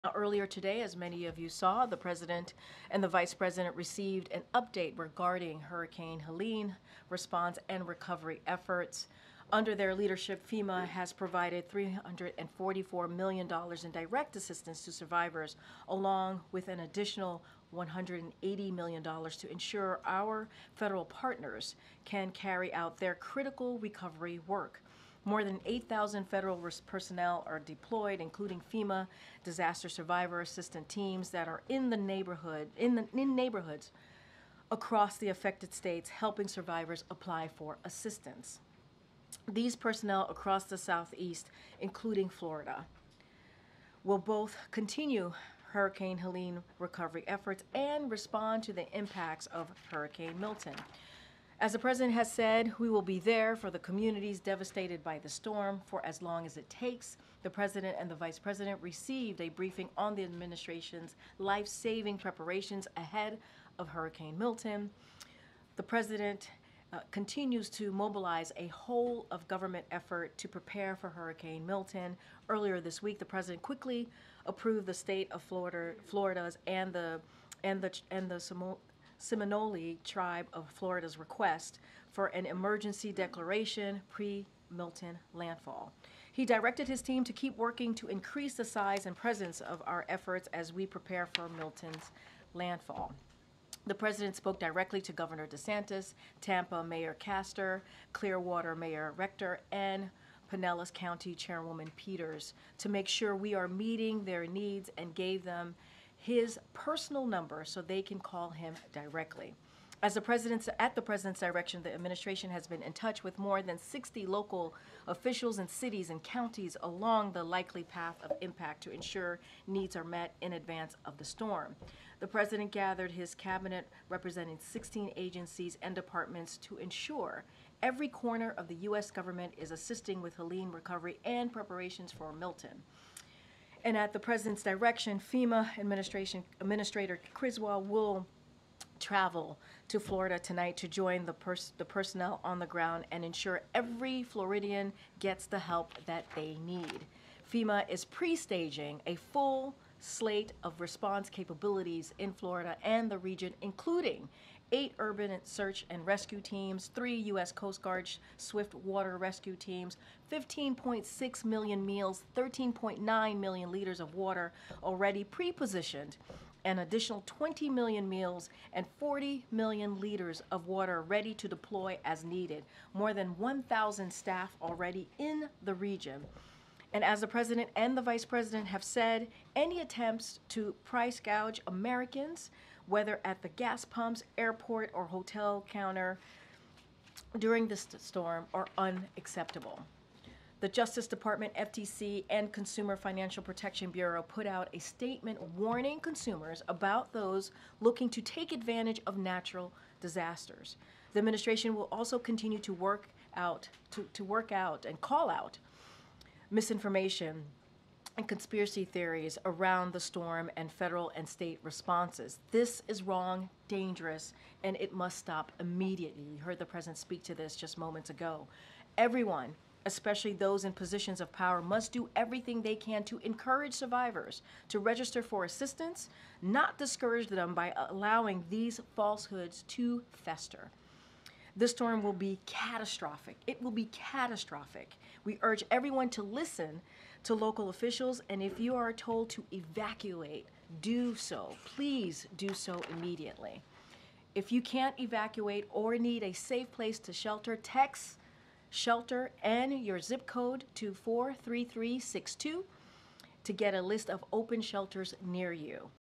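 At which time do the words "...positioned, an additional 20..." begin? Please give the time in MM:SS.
02:45.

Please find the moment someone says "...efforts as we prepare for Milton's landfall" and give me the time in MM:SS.
01:30.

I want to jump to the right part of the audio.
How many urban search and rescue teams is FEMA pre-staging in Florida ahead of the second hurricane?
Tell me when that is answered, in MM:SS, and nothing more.
02:34.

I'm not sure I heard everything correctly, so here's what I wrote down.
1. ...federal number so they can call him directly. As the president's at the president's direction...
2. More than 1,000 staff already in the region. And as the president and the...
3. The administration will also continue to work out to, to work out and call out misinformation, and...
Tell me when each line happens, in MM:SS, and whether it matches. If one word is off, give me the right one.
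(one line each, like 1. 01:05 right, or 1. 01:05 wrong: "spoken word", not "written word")
1. 01:46 wrong: "personal", not "federal"
2. 02:52 right
3. 03:21 right.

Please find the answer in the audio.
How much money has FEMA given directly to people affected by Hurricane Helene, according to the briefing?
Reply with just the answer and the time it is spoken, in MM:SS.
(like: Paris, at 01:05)
$344 million, at 00:11.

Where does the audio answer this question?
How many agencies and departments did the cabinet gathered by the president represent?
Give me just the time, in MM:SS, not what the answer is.
02:04.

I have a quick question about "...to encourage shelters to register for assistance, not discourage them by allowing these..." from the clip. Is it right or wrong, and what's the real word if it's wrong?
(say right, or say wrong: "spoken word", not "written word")
wrong: "survivors", not "shelters".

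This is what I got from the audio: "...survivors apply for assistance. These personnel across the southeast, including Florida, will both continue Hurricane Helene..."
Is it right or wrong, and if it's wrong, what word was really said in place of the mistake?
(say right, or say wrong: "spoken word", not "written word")
right.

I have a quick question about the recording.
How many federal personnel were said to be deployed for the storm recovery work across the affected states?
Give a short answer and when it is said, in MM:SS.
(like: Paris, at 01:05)
8,000, at 00:25.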